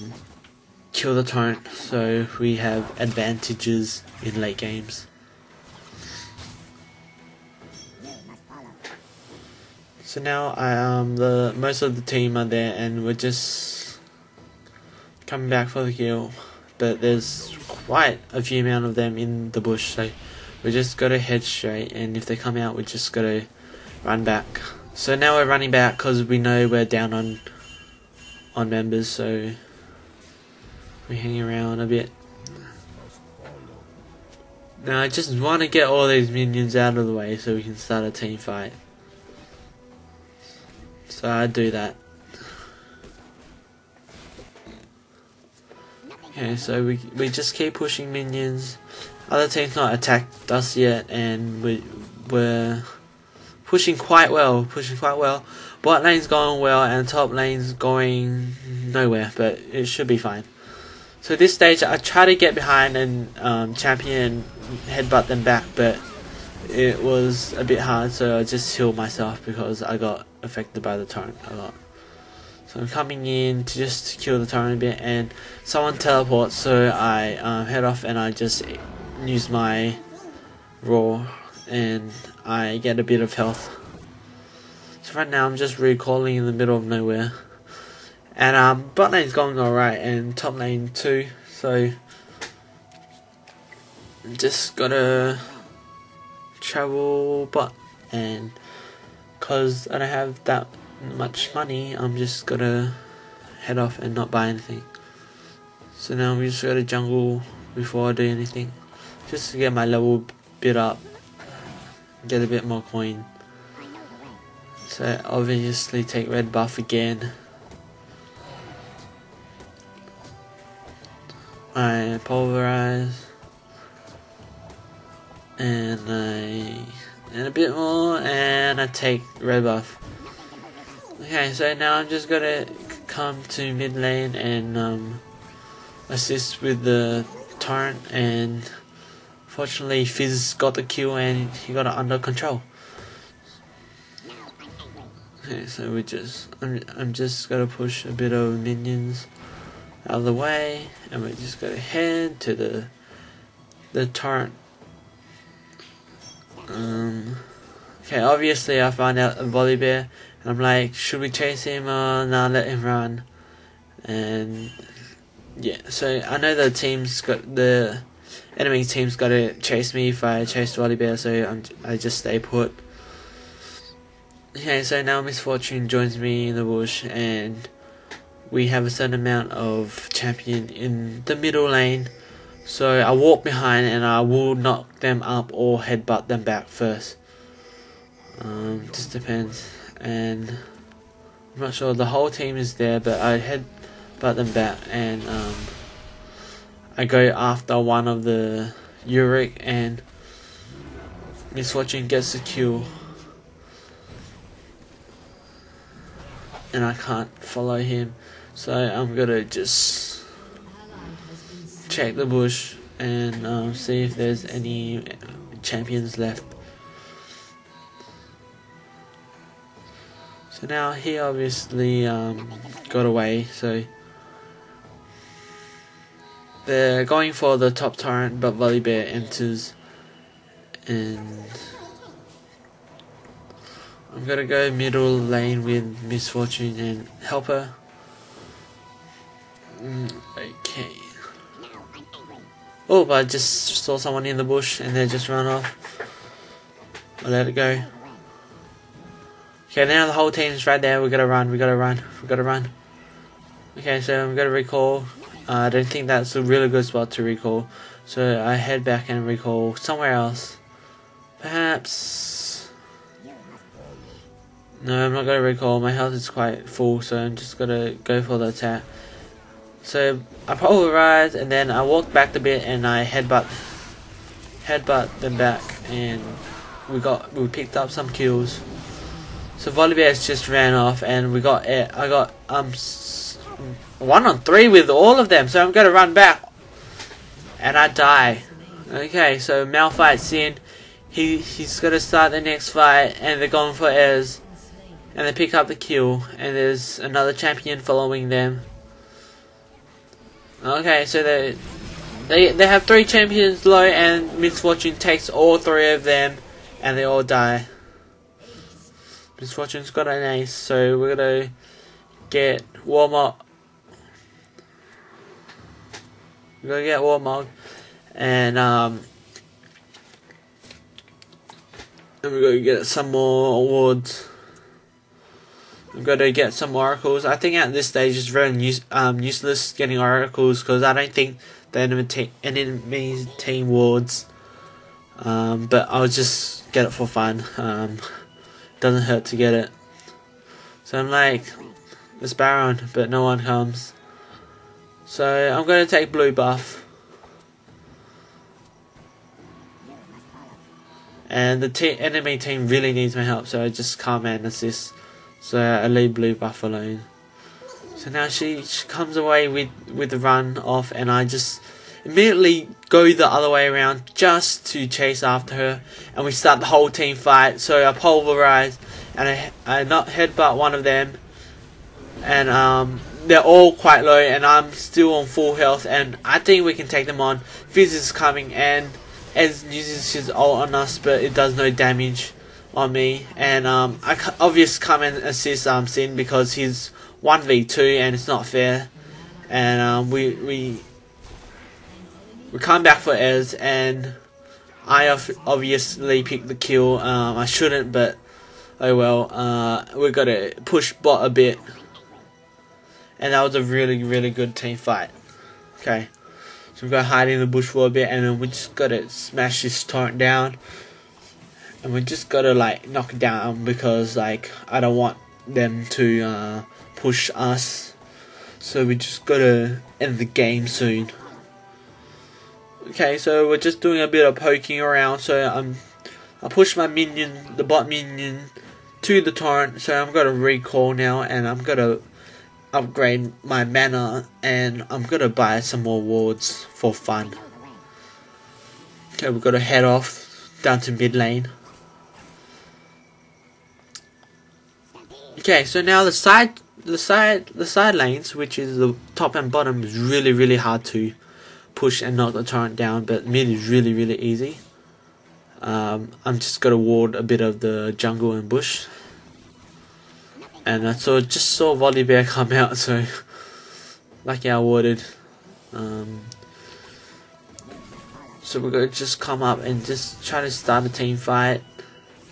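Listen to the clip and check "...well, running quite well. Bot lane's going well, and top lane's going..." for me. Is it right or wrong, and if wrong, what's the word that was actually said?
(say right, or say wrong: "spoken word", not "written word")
wrong: "pushing", not "running".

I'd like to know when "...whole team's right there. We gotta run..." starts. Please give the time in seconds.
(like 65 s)
250 s.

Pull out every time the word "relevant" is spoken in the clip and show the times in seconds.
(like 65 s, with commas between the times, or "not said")
not said.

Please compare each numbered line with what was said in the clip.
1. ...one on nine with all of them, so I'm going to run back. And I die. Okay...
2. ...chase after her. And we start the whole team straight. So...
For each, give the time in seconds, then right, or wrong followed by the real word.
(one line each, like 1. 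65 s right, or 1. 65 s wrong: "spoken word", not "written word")
1. 284 s wrong: "three", not "nine"
2. 364 s wrong: "fight", not "straight".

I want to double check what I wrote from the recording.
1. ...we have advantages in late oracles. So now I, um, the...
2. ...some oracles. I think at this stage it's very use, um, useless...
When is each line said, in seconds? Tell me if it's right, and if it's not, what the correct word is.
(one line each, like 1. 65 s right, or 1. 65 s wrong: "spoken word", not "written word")
1. 2 s wrong: "games", not "oracles"
2. 326 s right.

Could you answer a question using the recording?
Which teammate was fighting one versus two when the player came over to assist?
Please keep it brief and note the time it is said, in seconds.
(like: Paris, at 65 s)
Sin, at 385 s.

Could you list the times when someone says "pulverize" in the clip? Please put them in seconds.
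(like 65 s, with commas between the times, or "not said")
122 s, 367 s.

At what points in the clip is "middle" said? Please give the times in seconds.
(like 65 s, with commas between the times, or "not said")
86 s, 181 s, 234 s.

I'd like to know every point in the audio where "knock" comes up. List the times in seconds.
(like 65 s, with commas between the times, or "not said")
184 s, 412 s, 452 s.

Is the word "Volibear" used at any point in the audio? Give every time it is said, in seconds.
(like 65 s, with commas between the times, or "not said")
159 s, 170 s, 228 s, 279 s, 461 s.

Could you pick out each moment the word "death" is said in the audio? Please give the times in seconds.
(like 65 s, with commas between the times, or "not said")
not said.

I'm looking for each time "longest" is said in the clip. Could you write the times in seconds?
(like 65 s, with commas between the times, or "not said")
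not said.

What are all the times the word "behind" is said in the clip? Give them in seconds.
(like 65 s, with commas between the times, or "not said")
62 s, 183 s.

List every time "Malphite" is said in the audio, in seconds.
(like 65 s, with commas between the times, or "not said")
289 s.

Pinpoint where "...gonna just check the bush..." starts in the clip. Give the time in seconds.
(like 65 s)
209 s.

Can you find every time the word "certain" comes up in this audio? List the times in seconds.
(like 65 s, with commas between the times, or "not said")
178 s.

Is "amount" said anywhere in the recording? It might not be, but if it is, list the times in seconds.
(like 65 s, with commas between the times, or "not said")
18 s, 179 s.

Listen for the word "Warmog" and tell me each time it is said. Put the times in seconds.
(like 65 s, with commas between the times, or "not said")
312 s, 317 s.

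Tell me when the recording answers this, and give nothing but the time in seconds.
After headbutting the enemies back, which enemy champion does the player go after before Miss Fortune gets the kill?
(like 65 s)
197 s.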